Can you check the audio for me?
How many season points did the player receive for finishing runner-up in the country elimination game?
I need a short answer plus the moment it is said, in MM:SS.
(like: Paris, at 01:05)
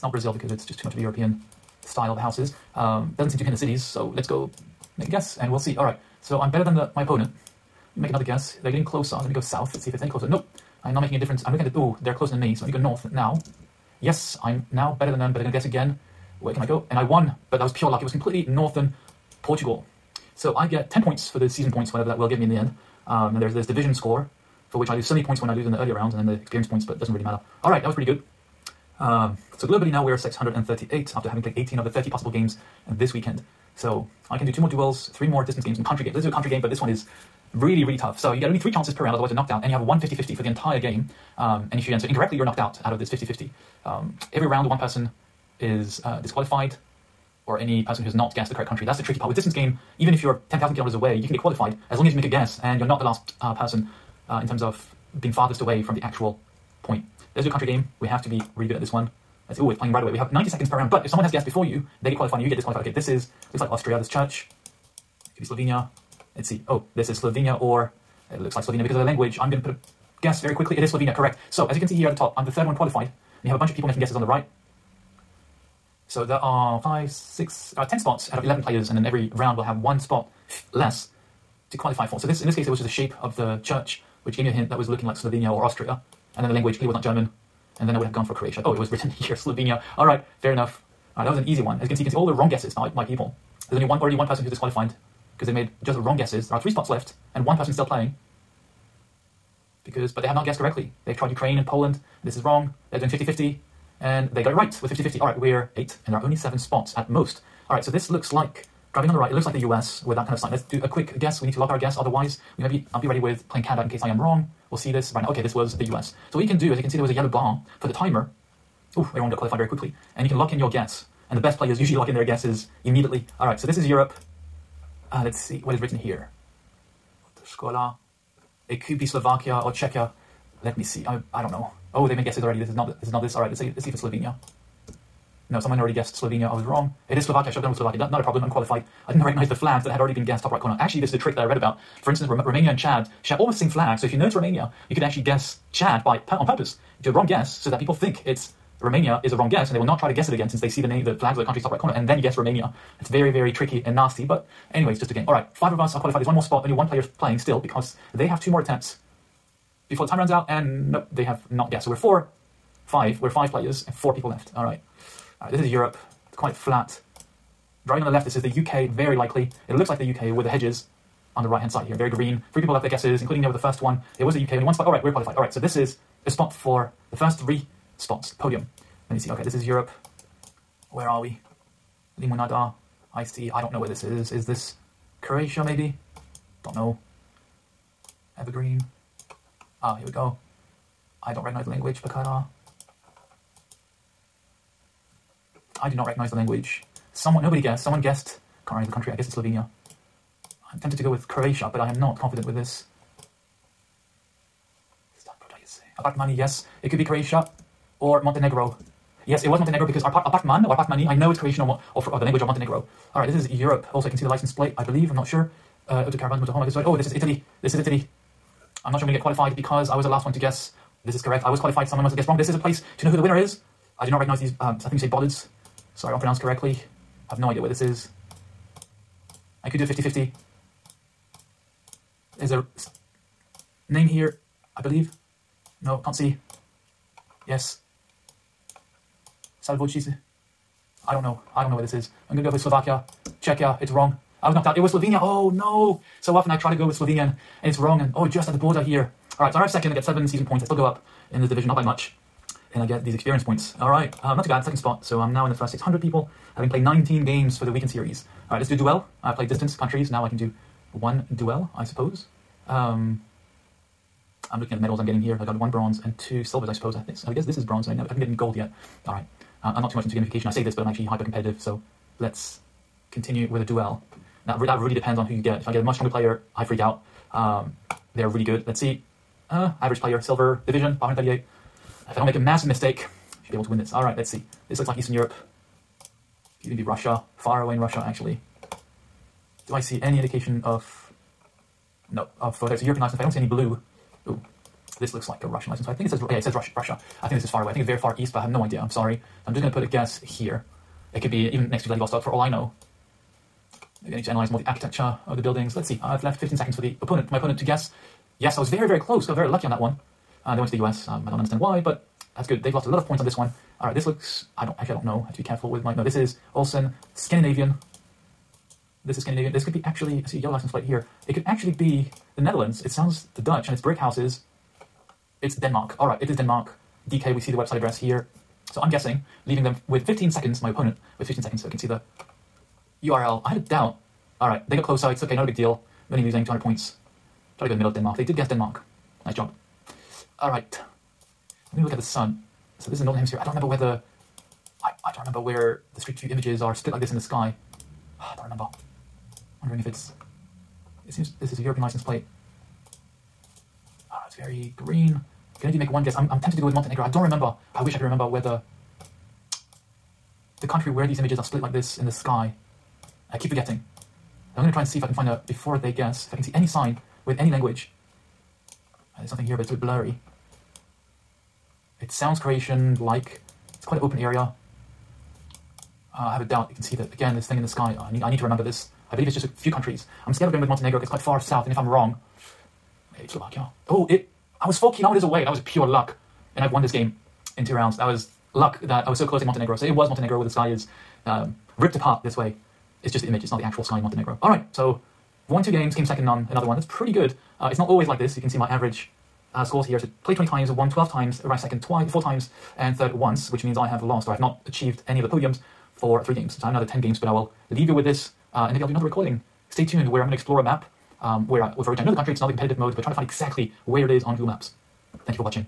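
7, at 04:10.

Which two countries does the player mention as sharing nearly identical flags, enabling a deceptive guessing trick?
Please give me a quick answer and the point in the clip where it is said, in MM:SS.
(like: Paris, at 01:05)
Romania and Chad, at 02:22.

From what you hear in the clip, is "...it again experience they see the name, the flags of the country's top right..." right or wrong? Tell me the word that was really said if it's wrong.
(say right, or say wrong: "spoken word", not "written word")
wrong: "since", not "experience".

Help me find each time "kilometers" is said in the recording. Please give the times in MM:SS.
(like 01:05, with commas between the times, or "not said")
00:50, 06:24.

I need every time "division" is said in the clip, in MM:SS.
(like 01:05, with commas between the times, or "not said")
00:23, 04:11, 04:40.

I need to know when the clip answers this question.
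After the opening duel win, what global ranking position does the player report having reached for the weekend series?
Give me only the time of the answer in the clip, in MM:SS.
00:30.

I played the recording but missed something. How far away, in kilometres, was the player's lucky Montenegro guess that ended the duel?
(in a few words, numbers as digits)
4.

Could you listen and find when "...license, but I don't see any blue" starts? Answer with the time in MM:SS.
04:53.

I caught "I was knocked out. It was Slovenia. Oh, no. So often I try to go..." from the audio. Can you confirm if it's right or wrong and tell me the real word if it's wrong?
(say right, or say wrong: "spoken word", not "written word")
right.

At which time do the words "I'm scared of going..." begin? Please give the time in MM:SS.
06:20.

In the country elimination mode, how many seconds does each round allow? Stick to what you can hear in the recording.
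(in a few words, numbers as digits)
90.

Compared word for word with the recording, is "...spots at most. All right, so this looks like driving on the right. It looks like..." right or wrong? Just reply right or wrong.
right.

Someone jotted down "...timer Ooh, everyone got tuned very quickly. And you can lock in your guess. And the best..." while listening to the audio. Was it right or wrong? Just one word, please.
wrong.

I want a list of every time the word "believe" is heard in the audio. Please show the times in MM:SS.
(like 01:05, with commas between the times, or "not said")
03:34, 03:54, 06:19.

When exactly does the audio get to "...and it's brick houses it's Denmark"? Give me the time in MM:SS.
05:23.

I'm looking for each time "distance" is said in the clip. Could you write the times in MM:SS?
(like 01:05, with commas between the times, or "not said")
00:35, 00:49, 04:19.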